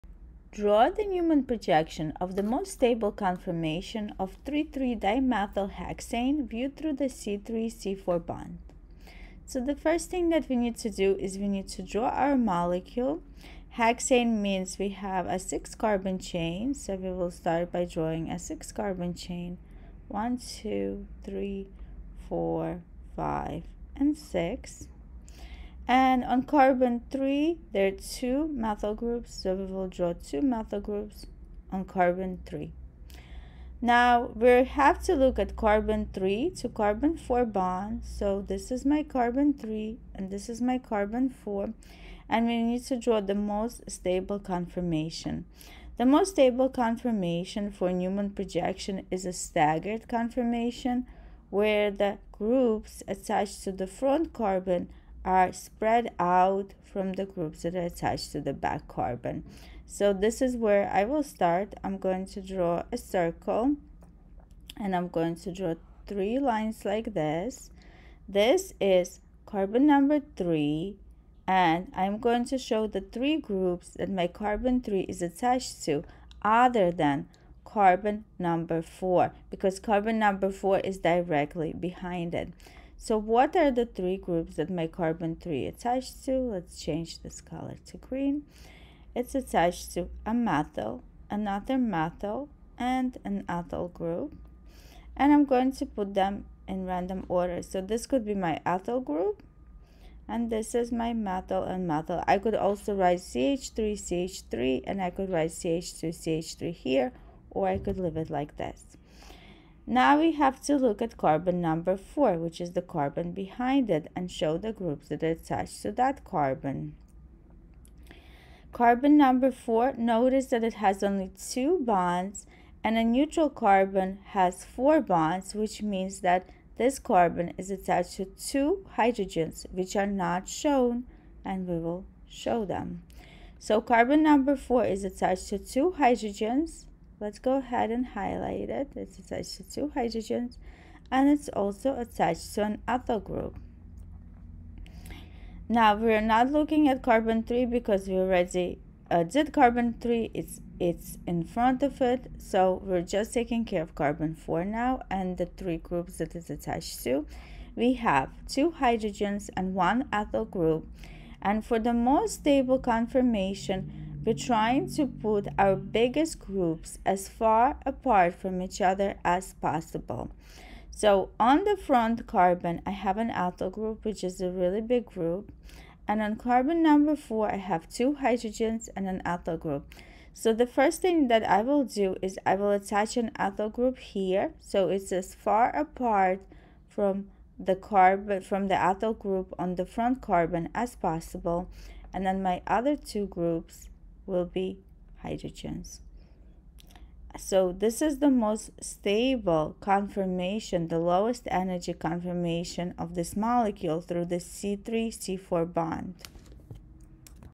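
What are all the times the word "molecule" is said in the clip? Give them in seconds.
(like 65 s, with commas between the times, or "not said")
12 s, 203 s.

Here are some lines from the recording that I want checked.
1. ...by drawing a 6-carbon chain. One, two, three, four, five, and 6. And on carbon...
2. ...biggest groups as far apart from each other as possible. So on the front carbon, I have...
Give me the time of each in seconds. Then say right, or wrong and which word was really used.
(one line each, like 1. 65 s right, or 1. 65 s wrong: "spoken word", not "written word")
1. 17 s right
2. 165 s right.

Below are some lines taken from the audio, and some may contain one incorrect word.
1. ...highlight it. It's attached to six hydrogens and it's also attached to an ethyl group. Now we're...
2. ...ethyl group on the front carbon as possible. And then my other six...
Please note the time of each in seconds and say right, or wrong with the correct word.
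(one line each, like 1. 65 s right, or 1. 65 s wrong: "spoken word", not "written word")
1. 138 s wrong: "two", not "six"
2. 188 s wrong: "two", not "six".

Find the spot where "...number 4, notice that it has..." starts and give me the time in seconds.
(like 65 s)
119 s.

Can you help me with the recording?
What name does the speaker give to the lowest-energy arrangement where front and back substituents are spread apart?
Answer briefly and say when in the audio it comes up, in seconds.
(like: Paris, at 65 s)
staggered conformation, at 49 s.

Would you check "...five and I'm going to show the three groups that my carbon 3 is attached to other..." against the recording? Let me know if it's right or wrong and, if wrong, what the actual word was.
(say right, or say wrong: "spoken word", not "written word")
wrong: "three", not "five".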